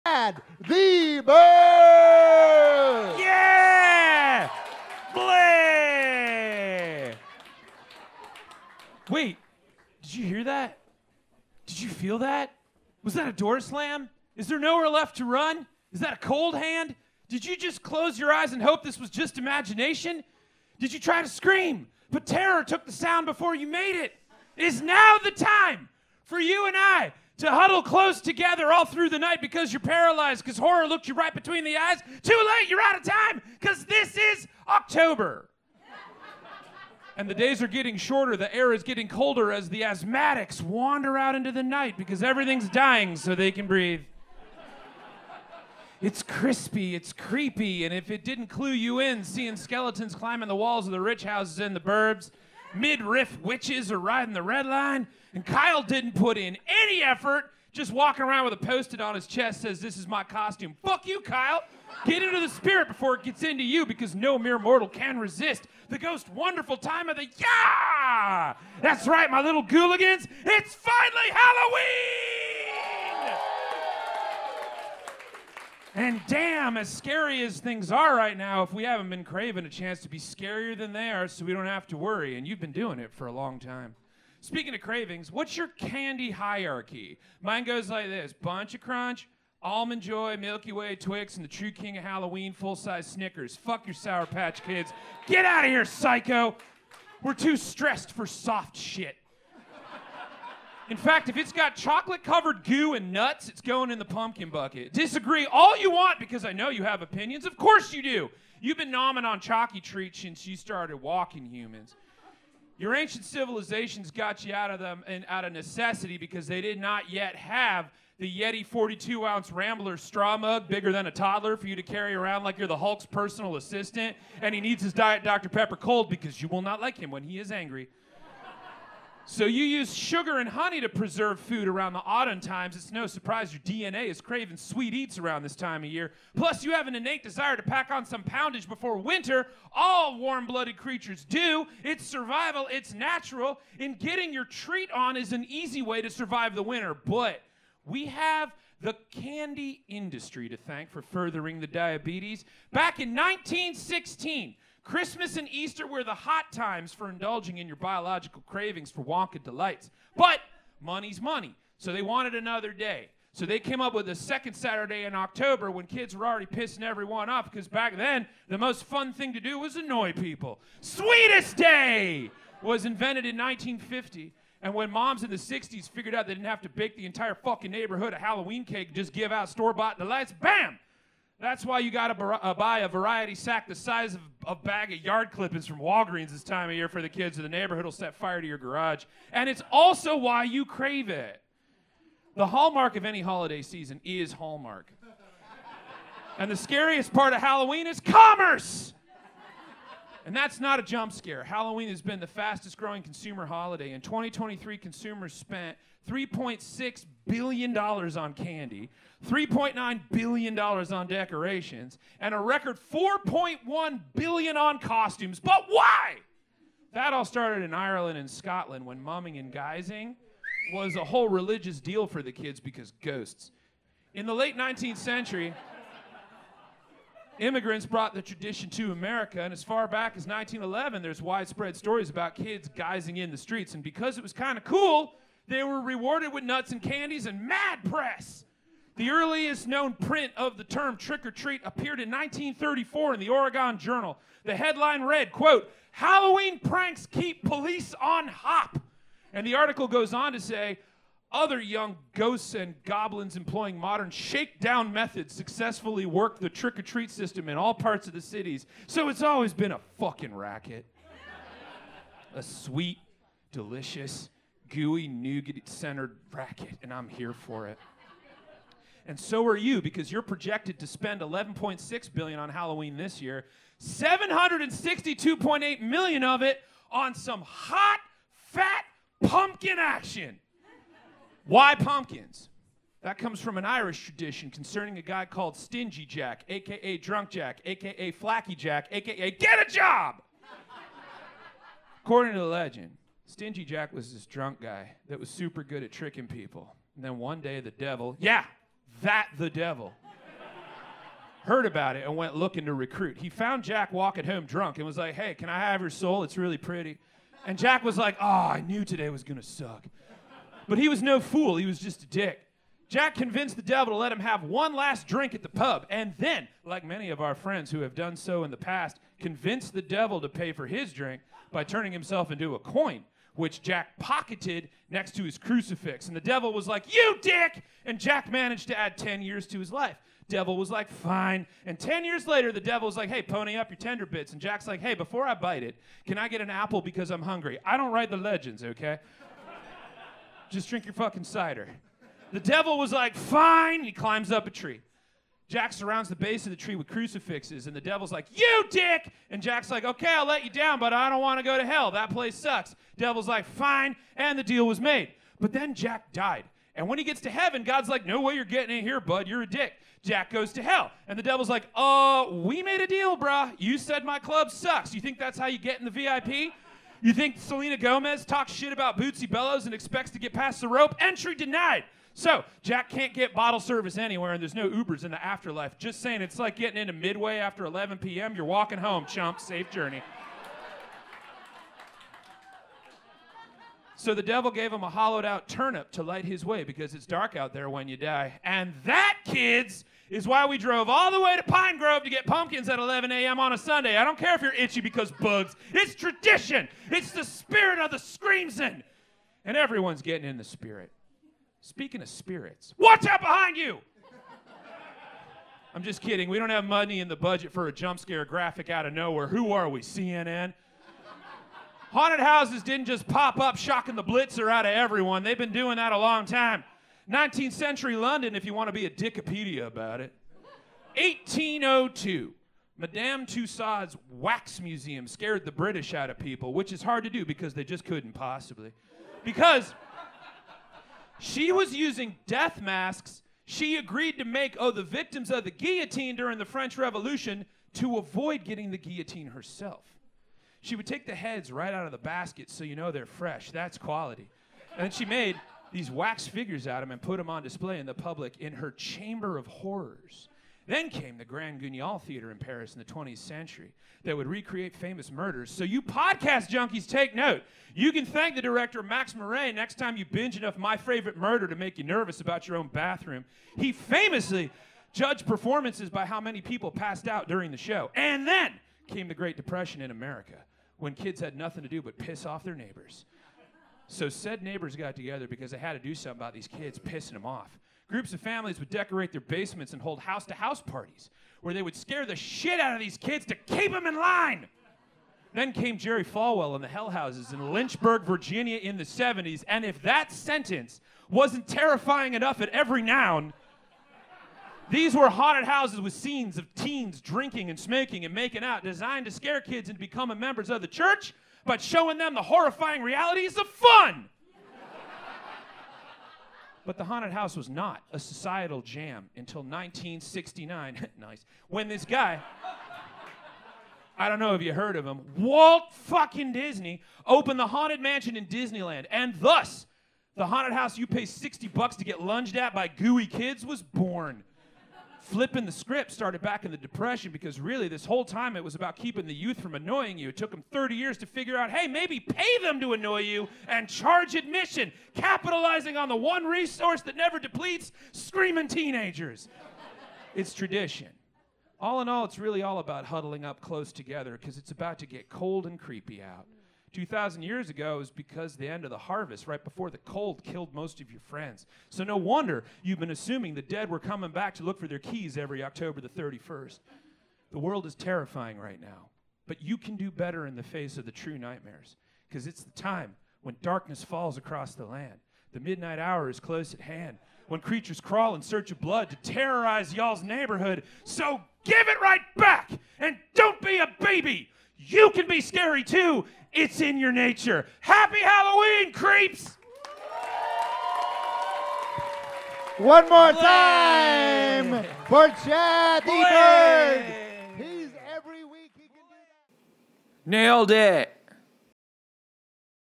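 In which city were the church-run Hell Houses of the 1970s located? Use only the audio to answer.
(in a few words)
Lynchburg, Virginia.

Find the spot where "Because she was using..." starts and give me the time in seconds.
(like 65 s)
429 s.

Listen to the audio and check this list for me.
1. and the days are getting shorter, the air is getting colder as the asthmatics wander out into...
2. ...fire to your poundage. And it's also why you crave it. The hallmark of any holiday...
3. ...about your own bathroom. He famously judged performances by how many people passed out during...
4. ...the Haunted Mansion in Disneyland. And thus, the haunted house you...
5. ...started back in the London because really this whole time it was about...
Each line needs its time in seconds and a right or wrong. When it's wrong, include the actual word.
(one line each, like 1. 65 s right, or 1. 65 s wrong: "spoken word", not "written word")
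1. 37 s right
2. 188 s wrong: "garage", not "poundage"
3. 462 s right
4. 517 s right
5. 525 s wrong: "Depression", not "London".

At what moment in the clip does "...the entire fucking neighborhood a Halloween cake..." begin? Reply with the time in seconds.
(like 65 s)
176 s.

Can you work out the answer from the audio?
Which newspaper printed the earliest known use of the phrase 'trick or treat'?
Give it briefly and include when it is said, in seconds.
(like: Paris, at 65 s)
Oregon Journal, at 243 s.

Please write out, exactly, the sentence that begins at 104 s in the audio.
Disagree all you want because I know you have opinions.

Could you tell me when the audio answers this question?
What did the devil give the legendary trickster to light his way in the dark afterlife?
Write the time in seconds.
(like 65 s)
384 s.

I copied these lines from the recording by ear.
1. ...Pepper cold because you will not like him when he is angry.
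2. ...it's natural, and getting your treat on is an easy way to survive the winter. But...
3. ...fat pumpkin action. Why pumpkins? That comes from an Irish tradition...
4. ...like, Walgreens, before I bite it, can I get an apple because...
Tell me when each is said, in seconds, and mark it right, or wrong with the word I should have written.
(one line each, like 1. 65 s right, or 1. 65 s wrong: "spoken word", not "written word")
1. 125 s right
2. 142 s right
3. 278 s right
4. 334 s wrong: "Hey", not "Walgreens".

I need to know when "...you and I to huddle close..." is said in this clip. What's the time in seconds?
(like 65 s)
26 s.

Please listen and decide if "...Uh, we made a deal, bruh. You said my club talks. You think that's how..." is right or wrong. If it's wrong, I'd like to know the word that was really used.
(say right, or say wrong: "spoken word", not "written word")
wrong: "sucks", not "talks".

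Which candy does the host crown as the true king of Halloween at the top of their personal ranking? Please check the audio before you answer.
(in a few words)
full size Snickers.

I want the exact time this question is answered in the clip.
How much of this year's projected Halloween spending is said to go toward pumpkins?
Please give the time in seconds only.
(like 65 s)
273 s.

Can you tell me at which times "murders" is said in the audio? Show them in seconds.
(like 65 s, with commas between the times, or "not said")
455 s, 461 s.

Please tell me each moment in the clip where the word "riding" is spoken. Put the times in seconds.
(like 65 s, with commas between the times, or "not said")
53 s.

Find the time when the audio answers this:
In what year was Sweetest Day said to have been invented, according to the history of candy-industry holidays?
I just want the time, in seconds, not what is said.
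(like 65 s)
173 s.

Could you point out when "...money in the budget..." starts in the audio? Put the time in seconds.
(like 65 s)
406 s.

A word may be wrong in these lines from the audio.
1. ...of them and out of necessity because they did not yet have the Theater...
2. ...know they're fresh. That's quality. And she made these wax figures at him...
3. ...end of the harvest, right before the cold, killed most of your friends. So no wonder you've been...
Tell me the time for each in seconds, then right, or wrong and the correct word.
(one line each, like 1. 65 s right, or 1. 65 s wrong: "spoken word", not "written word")
1. 114 s wrong: "Yeti", not "Theater"
2. 442 s right
3. 548 s right.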